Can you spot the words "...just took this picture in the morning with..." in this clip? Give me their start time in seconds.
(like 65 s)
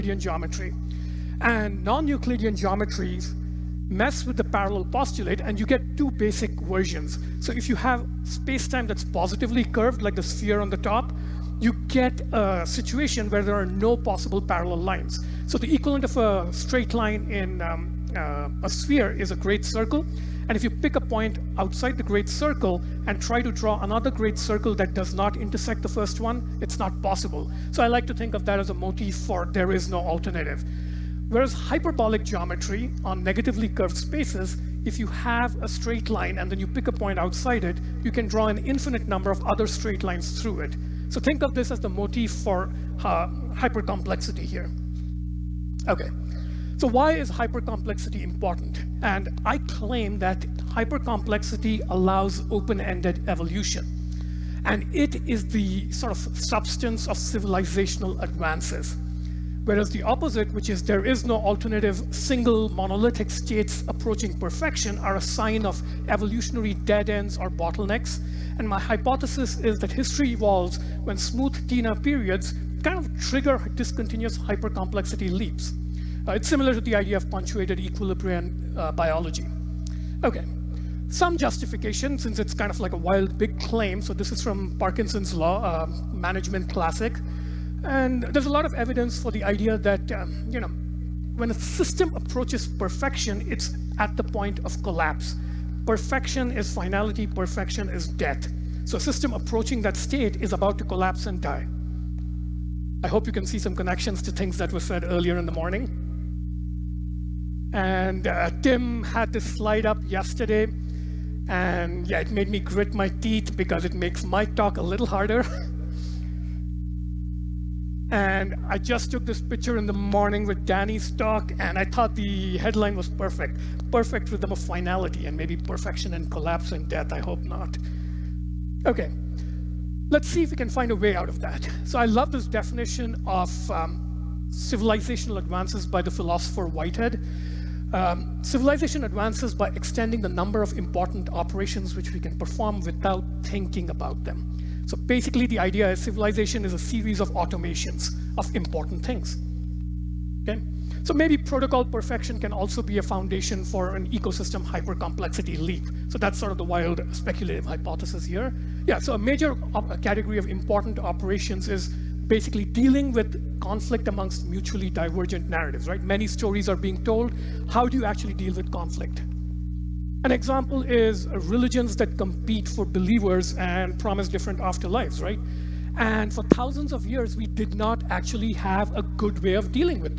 118 s.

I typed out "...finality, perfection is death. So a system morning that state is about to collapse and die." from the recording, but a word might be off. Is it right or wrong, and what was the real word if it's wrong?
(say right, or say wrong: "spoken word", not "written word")
wrong: "approaching", not "morning".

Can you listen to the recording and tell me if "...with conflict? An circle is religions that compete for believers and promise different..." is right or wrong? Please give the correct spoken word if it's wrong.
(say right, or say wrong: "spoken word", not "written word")
wrong: "example", not "circle".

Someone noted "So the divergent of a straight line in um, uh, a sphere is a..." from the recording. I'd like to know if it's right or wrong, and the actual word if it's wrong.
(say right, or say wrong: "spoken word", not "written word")
wrong: "equivalent", not "divergent".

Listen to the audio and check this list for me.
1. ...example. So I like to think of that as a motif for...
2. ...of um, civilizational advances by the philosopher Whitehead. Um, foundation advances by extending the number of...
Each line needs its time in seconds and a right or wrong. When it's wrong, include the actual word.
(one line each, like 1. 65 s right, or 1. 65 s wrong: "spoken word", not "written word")
1. 27 s wrong: "possible", not "example"
2. 133 s wrong: "civilization", not "foundation".